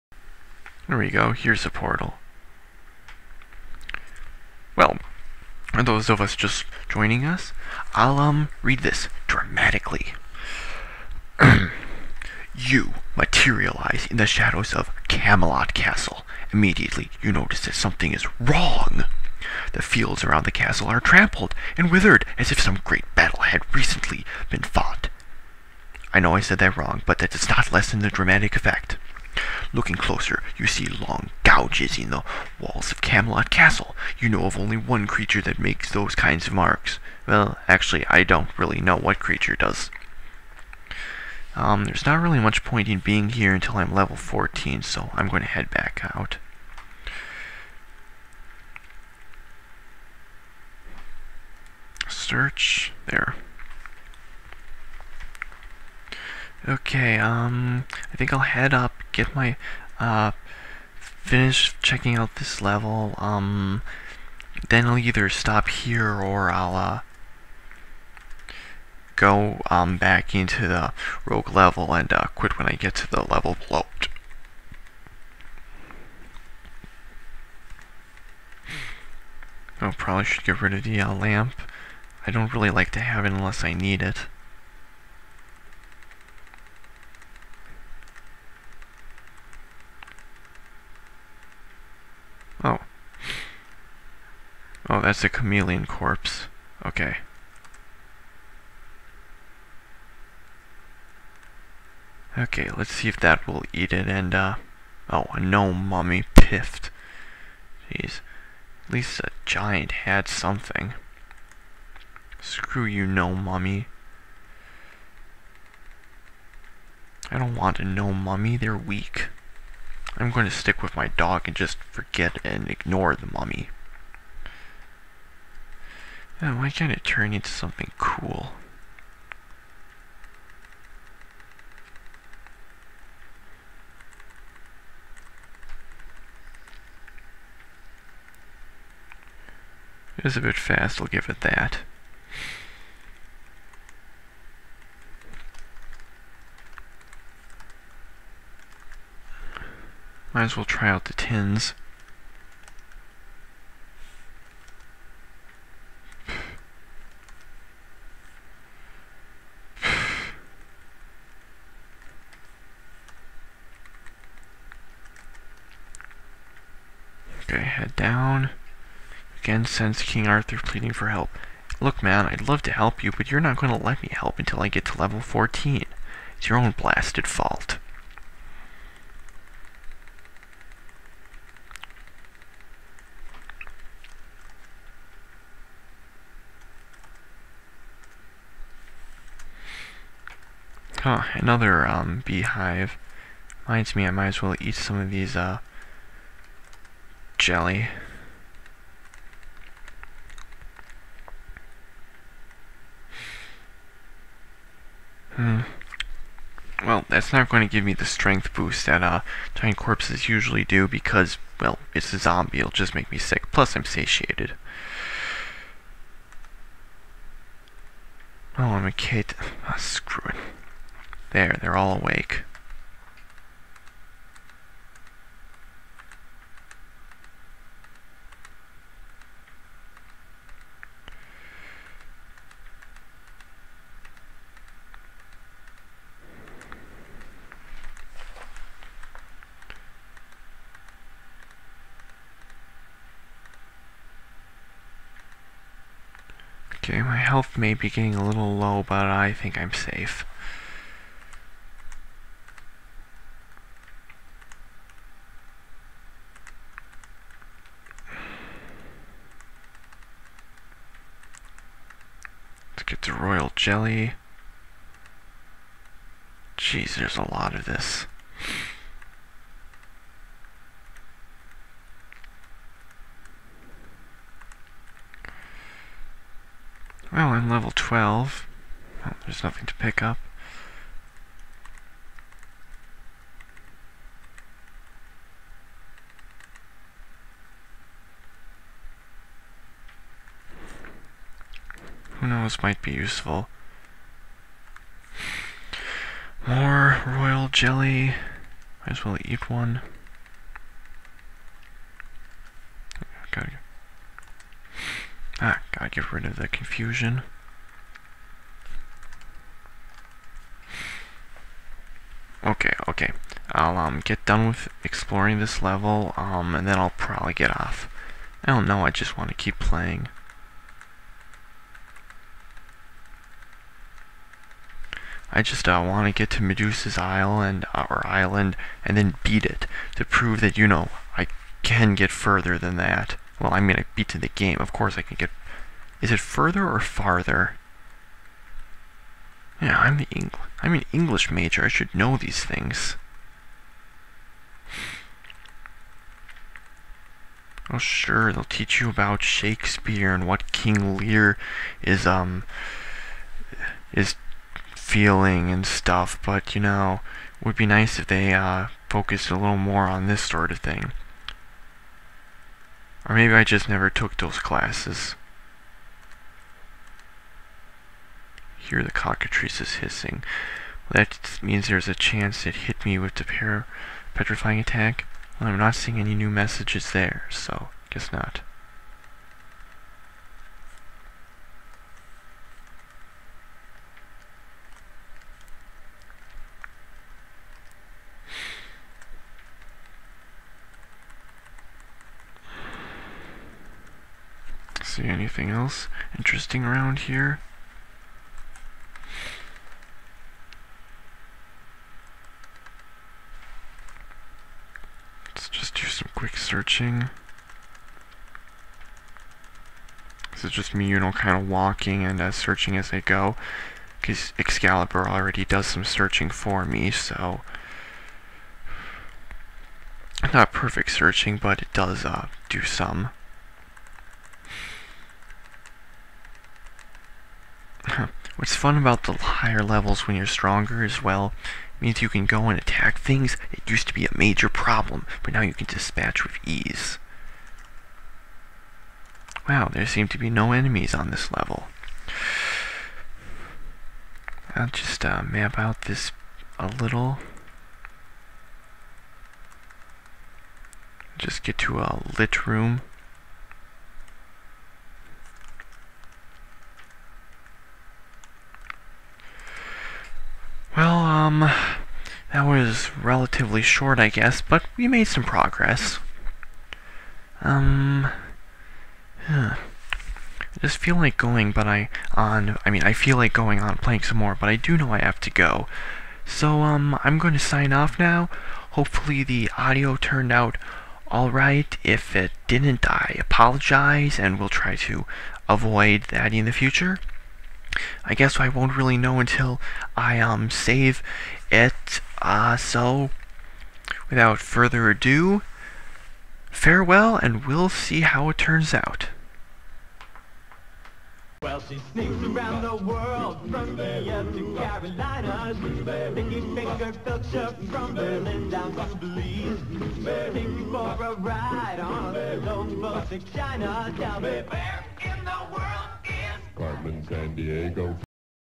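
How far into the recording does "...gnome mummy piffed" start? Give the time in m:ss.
1:45.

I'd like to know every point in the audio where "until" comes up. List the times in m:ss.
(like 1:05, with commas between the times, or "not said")
0:43, 2:54, 8:09.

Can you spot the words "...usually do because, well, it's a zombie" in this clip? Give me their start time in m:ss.
3:30.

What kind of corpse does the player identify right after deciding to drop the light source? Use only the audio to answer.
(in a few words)
Chameleon.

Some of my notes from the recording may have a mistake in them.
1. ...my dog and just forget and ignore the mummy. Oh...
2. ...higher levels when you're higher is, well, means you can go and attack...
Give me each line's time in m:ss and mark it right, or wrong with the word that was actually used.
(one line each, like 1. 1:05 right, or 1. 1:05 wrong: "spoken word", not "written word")
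1. 2:00 right
2. 7:09 wrong: "stronger", not "higher".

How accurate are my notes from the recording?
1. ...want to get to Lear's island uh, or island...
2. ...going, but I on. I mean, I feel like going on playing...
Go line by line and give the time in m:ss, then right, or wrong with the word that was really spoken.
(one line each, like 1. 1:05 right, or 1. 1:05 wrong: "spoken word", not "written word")
1. 5:25 wrong: "Medusa", not "Lear"
2. 7:51 right.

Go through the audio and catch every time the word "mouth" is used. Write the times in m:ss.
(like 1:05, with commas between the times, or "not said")
not said.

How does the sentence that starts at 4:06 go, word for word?
Okay, my health may be getting a little low, but I think I'm safe.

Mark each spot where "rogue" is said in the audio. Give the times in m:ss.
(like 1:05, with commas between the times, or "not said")
1:11.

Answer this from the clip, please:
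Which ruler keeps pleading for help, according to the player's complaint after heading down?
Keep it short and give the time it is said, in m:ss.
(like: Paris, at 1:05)
King Arthur, at 2:50.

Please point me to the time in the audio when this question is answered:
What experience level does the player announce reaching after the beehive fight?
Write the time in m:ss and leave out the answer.
4:37.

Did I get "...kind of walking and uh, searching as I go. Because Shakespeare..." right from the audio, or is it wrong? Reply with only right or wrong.
wrong.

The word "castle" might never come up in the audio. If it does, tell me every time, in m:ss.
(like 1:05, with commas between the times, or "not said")
0:15, 0:20, 0:33.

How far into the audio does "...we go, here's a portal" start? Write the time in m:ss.
0:00.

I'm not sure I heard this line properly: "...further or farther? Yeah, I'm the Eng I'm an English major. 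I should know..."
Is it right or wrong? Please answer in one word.
right.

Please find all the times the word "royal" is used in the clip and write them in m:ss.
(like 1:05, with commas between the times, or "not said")
4:23, 4:57.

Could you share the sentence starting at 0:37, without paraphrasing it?
Well, actually, I don't really know what creature does.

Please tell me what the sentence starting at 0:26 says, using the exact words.
I know I said that wrong, but that does not lessen the dramatic effect.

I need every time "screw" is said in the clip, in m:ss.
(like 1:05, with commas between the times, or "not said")
1:52, 3:39.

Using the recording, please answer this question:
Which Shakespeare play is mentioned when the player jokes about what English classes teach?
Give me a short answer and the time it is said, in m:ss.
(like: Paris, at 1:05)
King Lear, at 5:50.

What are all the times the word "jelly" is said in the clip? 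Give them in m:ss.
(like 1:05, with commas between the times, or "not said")
3:17, 4:23, 4:57.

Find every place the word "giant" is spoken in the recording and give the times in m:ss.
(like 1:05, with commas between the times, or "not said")
1:49, 3:29.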